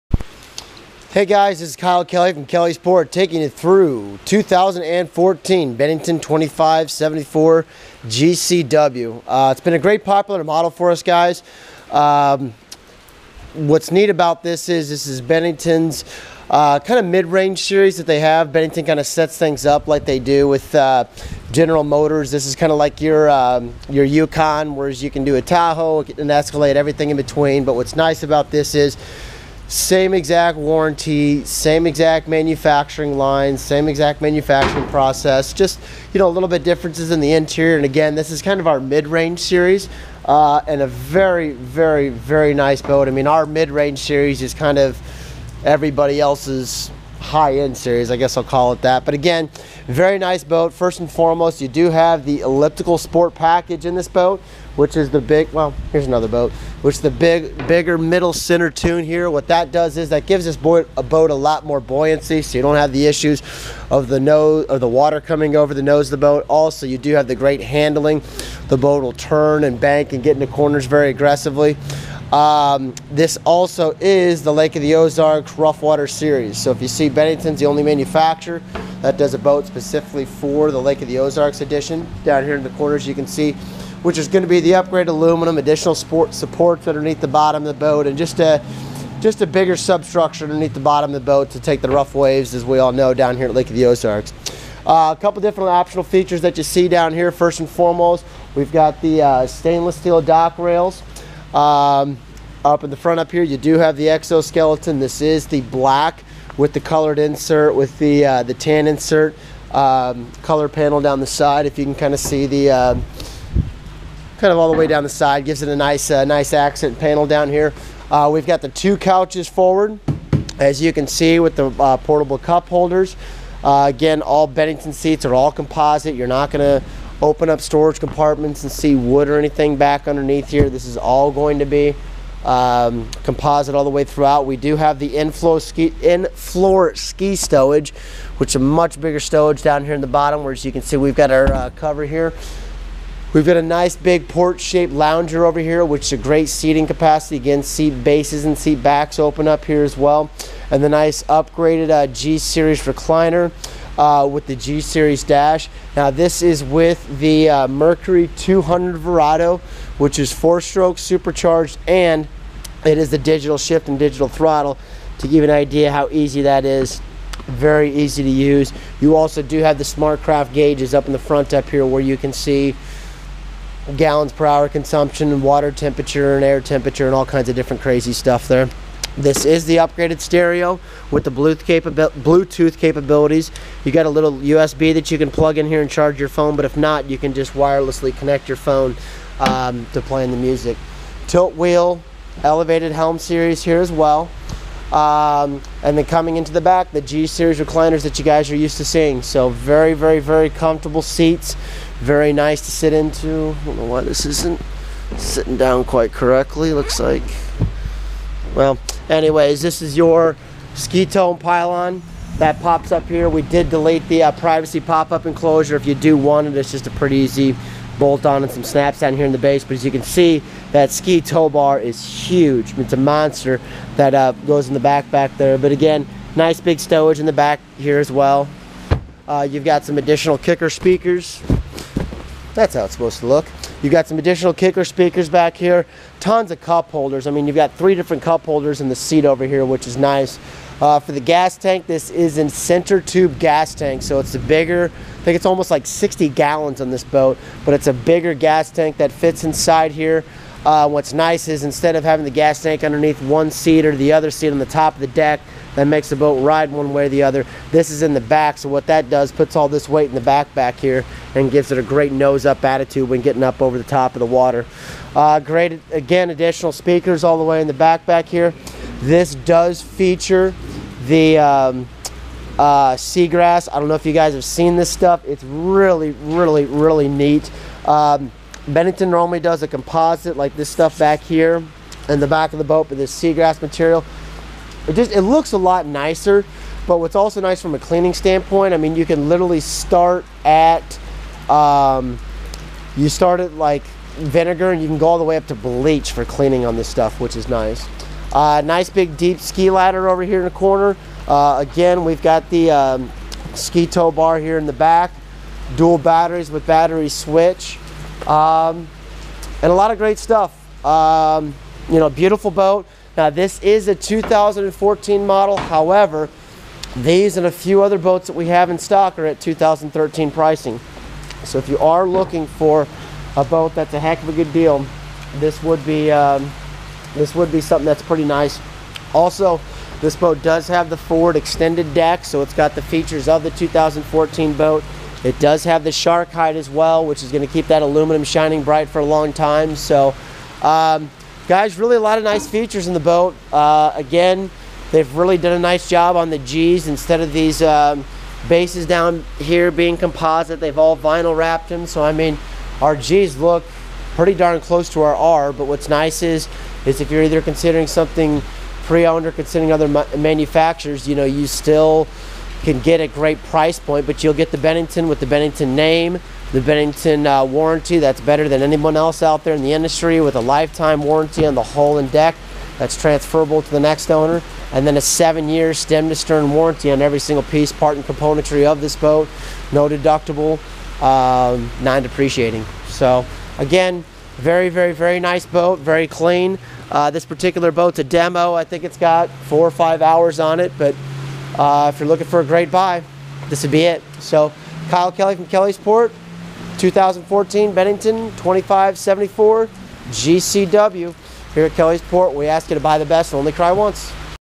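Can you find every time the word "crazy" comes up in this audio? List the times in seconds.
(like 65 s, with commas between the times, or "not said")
177 s.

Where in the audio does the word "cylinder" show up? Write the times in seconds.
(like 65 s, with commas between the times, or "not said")
not said.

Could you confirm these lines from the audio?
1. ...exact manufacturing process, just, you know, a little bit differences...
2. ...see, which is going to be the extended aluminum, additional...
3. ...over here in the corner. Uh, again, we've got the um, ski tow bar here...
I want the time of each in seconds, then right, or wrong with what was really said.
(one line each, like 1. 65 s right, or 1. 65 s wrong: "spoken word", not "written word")
1. 33 s right
2. 83 s wrong: "upgraded", not "extended"
3. 300 s right.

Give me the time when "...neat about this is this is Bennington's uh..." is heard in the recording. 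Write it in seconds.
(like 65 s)
13 s.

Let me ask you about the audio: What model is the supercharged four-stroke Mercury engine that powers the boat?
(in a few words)
200 Verado.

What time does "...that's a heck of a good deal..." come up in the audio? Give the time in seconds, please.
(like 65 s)
323 s.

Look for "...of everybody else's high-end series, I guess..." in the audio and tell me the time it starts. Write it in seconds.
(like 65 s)
44 s.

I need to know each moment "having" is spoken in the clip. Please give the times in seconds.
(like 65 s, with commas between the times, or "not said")
252 s.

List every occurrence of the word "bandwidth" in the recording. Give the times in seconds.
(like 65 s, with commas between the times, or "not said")
not said.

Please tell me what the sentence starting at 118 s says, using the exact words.
Uh, we've got the two couches forward, as you can see with the uh, portable cup holders.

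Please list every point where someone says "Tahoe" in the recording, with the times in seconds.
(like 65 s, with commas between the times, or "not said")
25 s.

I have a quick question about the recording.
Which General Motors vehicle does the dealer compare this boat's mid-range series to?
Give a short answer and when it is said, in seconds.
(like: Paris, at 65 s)
Yukon, at 24 s.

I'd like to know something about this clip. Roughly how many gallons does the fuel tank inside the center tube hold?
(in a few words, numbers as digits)
60.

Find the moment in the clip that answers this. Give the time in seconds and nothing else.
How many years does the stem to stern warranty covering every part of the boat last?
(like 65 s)
375 s.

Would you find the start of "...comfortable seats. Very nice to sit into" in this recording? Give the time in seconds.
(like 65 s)
200 s.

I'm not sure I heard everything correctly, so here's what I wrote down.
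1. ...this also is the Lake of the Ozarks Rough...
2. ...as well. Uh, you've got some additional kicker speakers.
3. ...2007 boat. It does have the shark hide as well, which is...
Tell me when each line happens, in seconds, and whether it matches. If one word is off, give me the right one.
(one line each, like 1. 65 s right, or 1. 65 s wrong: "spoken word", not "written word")
1. 73 s right
2. 227 s right
3. 333 s wrong: "2014", not "2007".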